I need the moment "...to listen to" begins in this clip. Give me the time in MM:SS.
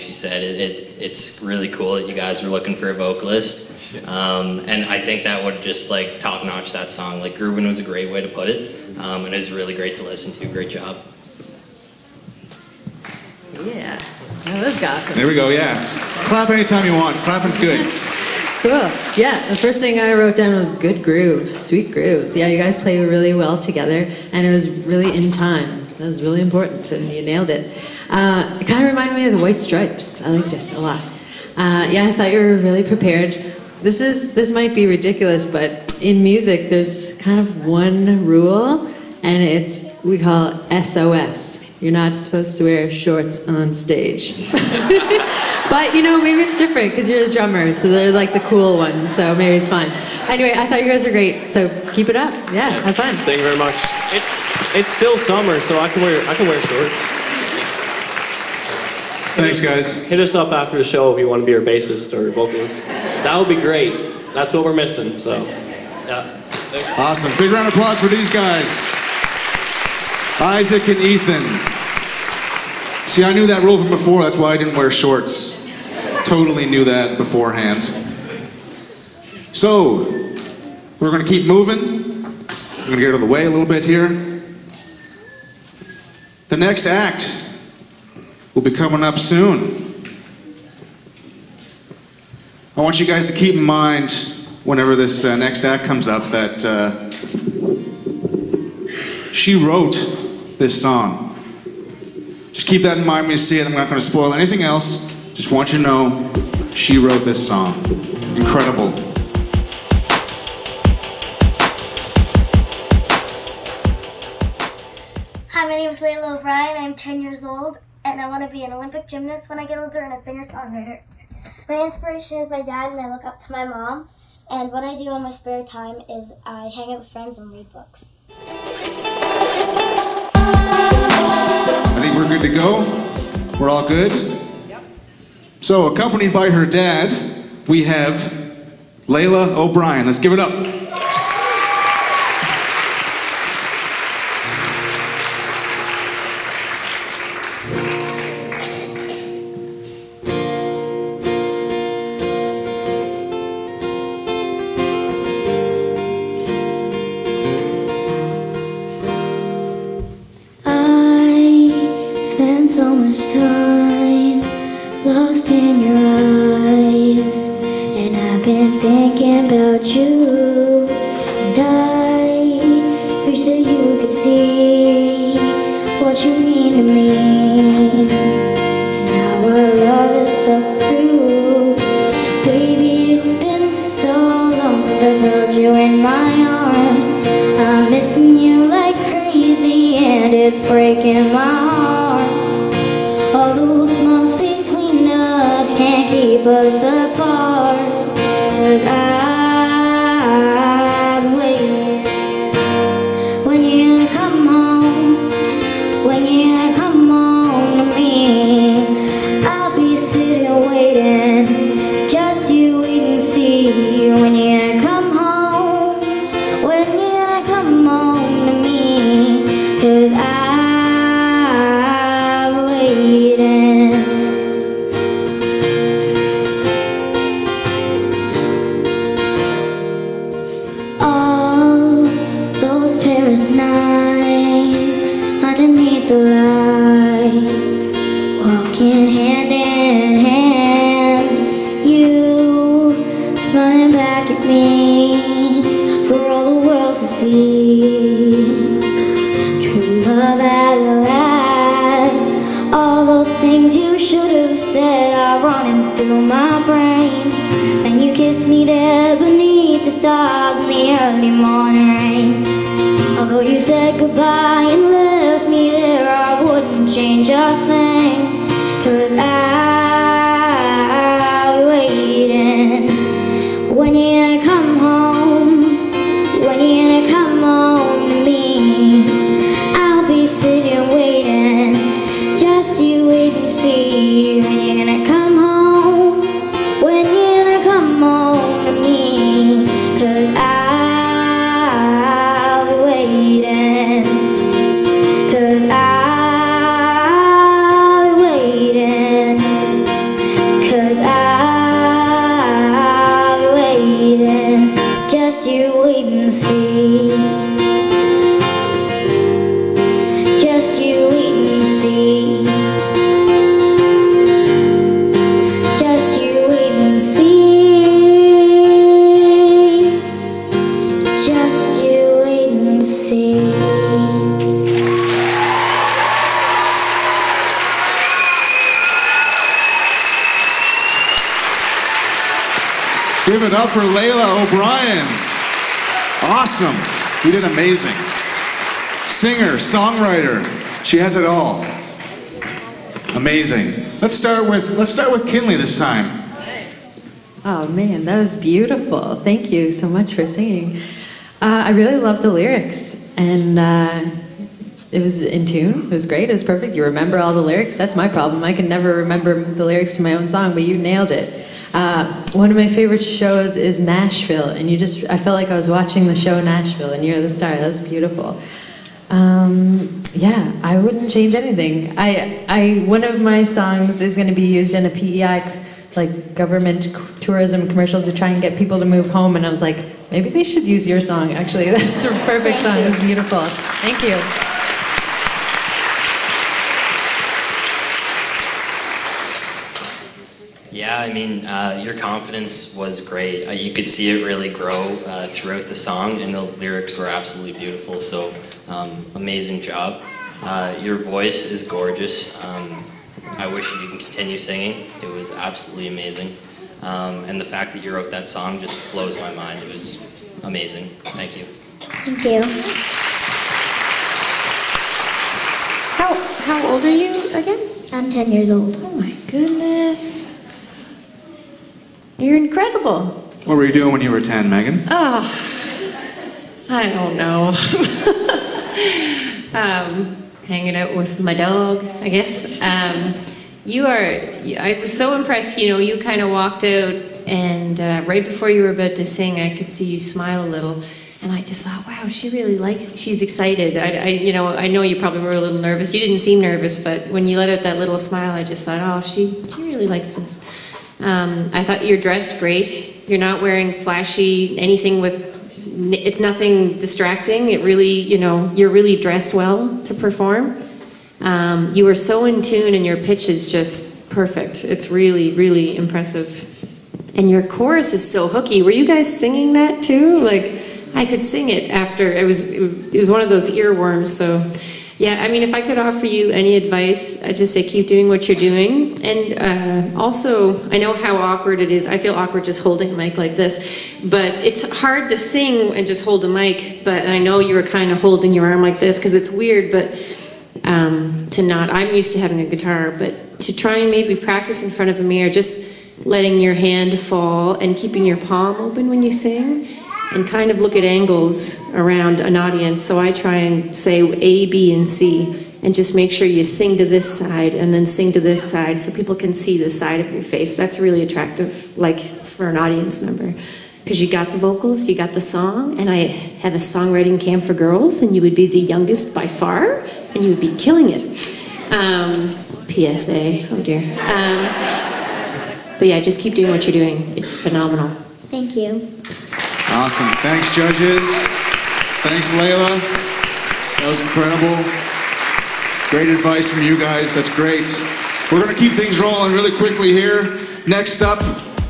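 00:09.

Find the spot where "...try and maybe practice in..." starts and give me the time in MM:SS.
08:13.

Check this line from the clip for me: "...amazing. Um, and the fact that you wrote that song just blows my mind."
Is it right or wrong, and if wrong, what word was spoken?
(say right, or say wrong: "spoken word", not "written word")
right.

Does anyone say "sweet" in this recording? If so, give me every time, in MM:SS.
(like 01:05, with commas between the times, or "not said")
00:21.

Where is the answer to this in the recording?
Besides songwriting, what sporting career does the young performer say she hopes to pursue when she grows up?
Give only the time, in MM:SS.
01:58.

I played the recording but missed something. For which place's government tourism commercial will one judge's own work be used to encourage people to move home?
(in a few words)
PEI.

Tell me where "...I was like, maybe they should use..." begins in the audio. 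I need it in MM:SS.
06:19.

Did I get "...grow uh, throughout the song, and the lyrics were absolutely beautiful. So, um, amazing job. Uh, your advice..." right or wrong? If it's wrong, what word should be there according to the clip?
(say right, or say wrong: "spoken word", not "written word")
wrong: "voice", not "advice".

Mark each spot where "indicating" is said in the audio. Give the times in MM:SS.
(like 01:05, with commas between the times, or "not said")
not said.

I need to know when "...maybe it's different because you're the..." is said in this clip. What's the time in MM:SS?
00:46.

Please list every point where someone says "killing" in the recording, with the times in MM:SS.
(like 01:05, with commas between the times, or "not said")
08:40.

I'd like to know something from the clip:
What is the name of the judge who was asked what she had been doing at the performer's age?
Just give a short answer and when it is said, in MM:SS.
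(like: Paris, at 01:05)
Megan, at 07:04.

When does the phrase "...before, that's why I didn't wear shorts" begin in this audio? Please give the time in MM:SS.
01:13.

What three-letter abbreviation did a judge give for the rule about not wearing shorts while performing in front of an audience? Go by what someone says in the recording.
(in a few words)
SOS.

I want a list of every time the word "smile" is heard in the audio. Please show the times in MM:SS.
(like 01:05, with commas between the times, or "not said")
07:19, 07:27.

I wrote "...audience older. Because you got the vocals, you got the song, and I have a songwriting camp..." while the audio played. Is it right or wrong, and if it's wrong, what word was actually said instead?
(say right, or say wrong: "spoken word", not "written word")
wrong: "member", not "older".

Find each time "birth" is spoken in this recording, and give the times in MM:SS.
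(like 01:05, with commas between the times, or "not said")
not said.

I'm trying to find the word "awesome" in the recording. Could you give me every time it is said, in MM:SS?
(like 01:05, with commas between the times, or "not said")
00:14, 01:06, 05:36, 08:49.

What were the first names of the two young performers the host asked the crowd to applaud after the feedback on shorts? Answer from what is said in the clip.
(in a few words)
Isaac and Ethan.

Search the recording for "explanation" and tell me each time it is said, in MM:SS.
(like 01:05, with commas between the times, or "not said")
not said.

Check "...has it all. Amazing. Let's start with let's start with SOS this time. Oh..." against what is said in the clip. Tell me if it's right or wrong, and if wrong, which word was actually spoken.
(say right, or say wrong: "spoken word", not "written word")
wrong: "Kinley", not "SOS".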